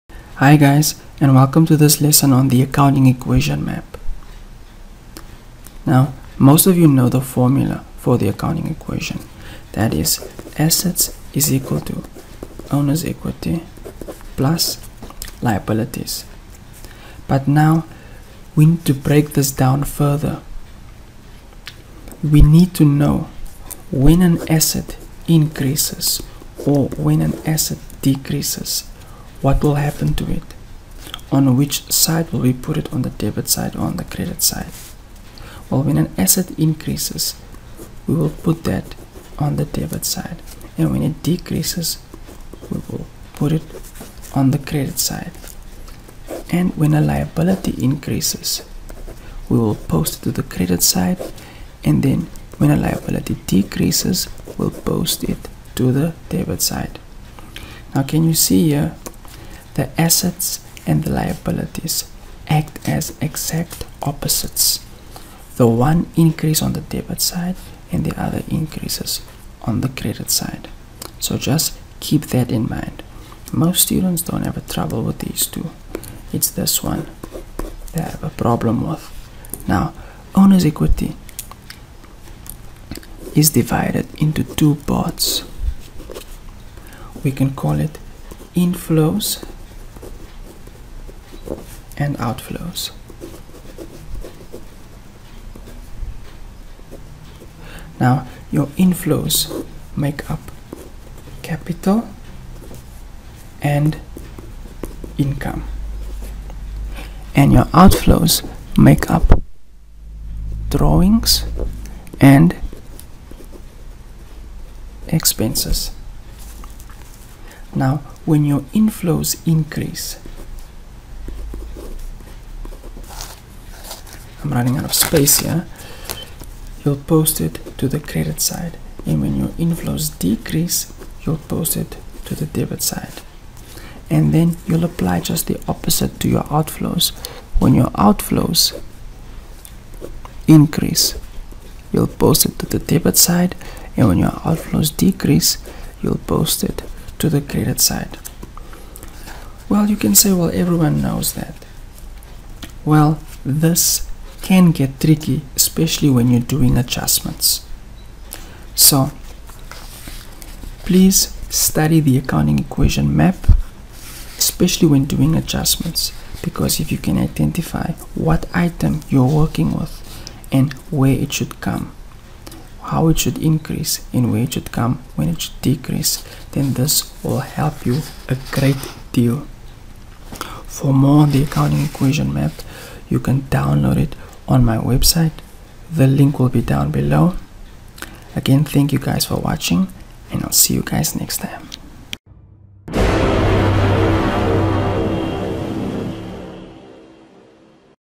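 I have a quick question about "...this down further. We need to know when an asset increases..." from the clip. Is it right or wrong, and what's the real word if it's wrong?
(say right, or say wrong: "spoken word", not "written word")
right.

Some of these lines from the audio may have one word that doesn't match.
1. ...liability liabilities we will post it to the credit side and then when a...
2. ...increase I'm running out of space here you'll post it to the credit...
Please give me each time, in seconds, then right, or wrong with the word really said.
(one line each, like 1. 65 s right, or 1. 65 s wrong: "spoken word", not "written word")
1. 47 s wrong: "increases", not "liabilities"
2. 119 s right.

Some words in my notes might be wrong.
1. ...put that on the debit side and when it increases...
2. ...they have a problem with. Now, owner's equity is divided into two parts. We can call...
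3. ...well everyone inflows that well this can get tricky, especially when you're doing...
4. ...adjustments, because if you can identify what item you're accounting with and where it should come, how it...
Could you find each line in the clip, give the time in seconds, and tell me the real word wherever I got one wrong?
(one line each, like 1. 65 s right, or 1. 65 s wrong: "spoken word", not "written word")
1. 38 s wrong: "decreases", not "increases"
2. 77 s right
3. 150 s wrong: "knows", not "inflows"
4. 165 s wrong: "working", not "accounting".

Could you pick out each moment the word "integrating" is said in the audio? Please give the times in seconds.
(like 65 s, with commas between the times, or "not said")
not said.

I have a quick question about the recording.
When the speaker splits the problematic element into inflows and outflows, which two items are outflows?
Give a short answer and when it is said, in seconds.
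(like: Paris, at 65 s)
Drawings and expenses, at 110 s.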